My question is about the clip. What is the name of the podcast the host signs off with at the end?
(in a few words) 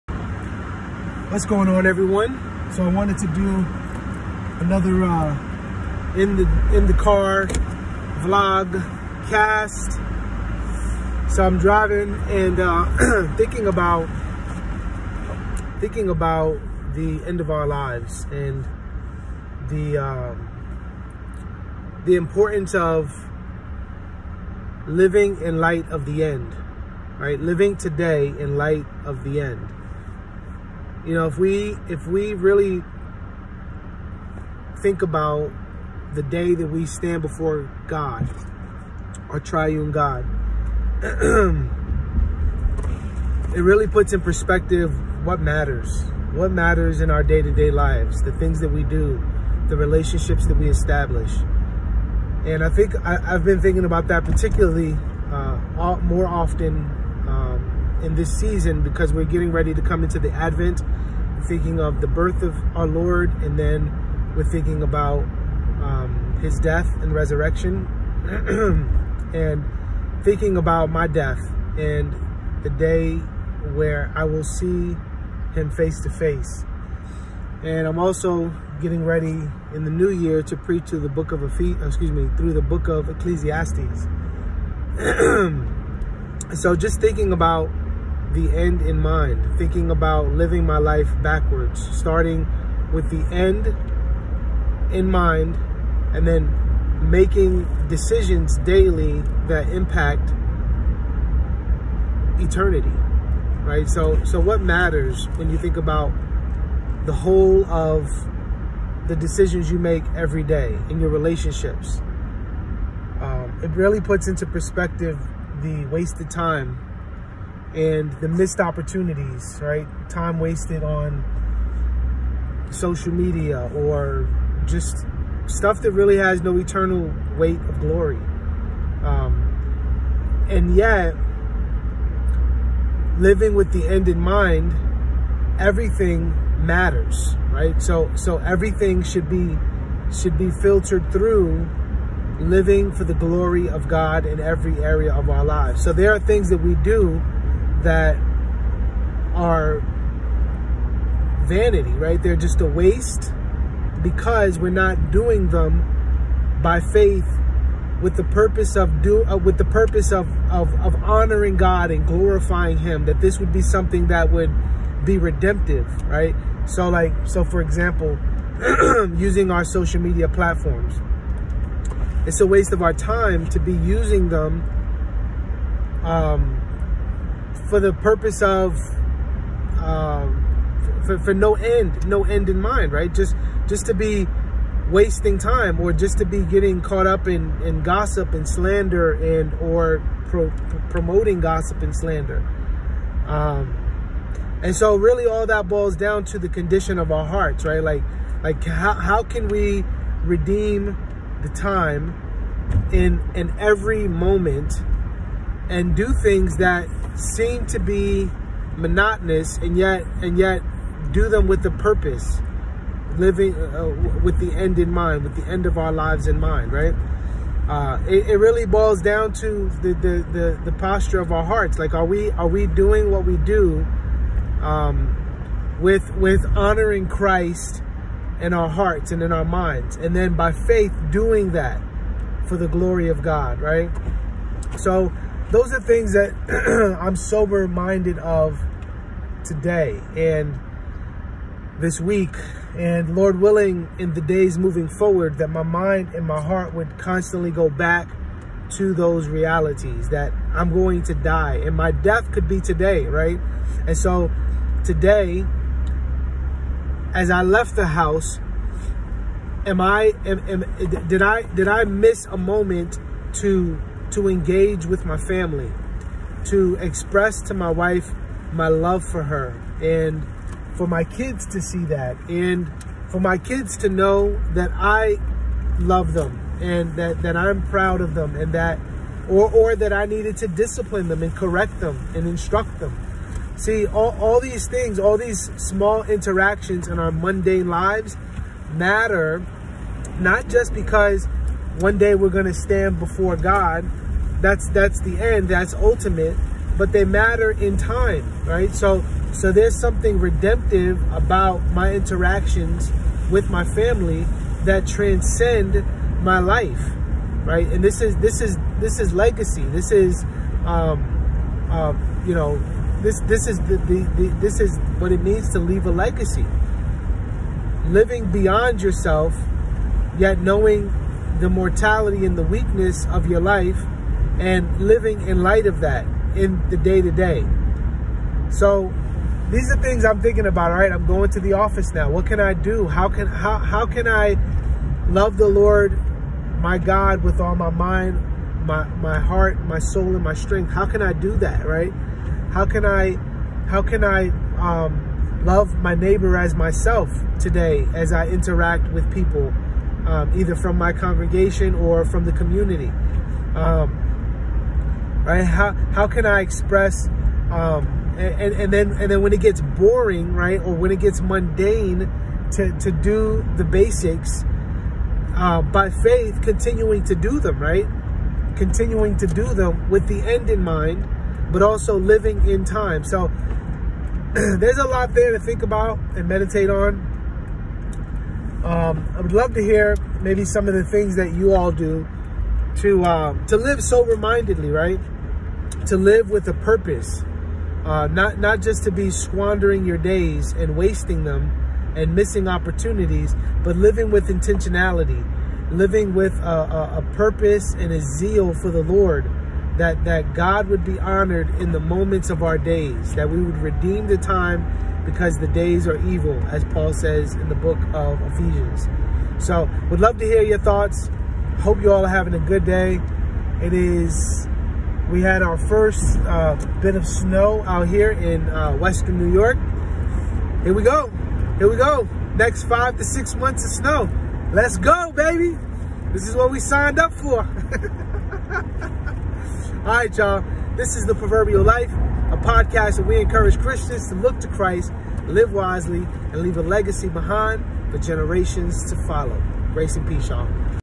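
The Proverbial Life.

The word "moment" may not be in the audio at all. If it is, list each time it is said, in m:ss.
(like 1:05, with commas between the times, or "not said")
3:24, 4:22, 6:41.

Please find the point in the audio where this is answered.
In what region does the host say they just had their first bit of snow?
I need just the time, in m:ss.
6:58.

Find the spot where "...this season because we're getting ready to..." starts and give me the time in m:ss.
0:58.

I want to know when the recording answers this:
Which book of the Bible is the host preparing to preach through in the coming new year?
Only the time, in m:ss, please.
1:23.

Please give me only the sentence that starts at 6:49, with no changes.
So would love to hear your thoughts.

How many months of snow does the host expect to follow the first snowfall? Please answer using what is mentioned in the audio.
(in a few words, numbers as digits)
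5 to 6.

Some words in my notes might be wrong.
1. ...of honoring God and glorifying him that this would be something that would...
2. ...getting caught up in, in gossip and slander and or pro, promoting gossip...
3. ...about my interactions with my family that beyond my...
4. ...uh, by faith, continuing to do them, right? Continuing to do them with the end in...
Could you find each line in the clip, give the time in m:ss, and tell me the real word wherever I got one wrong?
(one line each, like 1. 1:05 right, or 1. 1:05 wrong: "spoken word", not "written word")
1. 2:40 right
2. 3:06 right
3. 5:01 wrong: "transcend", not "beyond"
4. 6:05 right.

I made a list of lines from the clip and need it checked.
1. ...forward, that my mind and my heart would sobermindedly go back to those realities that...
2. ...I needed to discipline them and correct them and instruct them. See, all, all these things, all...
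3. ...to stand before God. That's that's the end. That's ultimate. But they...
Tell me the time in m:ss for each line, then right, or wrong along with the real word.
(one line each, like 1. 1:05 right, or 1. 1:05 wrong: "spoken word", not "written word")
1. 4:04 wrong: "constantly", not "sobermindedly"
2. 4:39 right
3. 4:52 right.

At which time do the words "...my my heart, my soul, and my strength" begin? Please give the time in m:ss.
5:38.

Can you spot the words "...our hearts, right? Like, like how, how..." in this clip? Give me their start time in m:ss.
3:17.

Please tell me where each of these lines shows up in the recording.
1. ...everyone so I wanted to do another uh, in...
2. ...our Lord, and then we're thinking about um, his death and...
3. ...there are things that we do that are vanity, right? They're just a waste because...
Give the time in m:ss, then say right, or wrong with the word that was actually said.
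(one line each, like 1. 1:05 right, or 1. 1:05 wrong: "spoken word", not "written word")
1. 0:01 right
2. 1:02 right
3. 2:25 right.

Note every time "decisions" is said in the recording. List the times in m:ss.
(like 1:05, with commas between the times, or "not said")
1:37, 1:49.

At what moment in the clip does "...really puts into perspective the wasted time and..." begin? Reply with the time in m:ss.
1:53.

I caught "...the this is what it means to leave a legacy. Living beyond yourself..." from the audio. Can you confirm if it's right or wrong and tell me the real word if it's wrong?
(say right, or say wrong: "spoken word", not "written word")
right.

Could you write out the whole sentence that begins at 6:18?
Um, I would love to hear maybe some of the things that you all do to um, to live sober-mindedly, right?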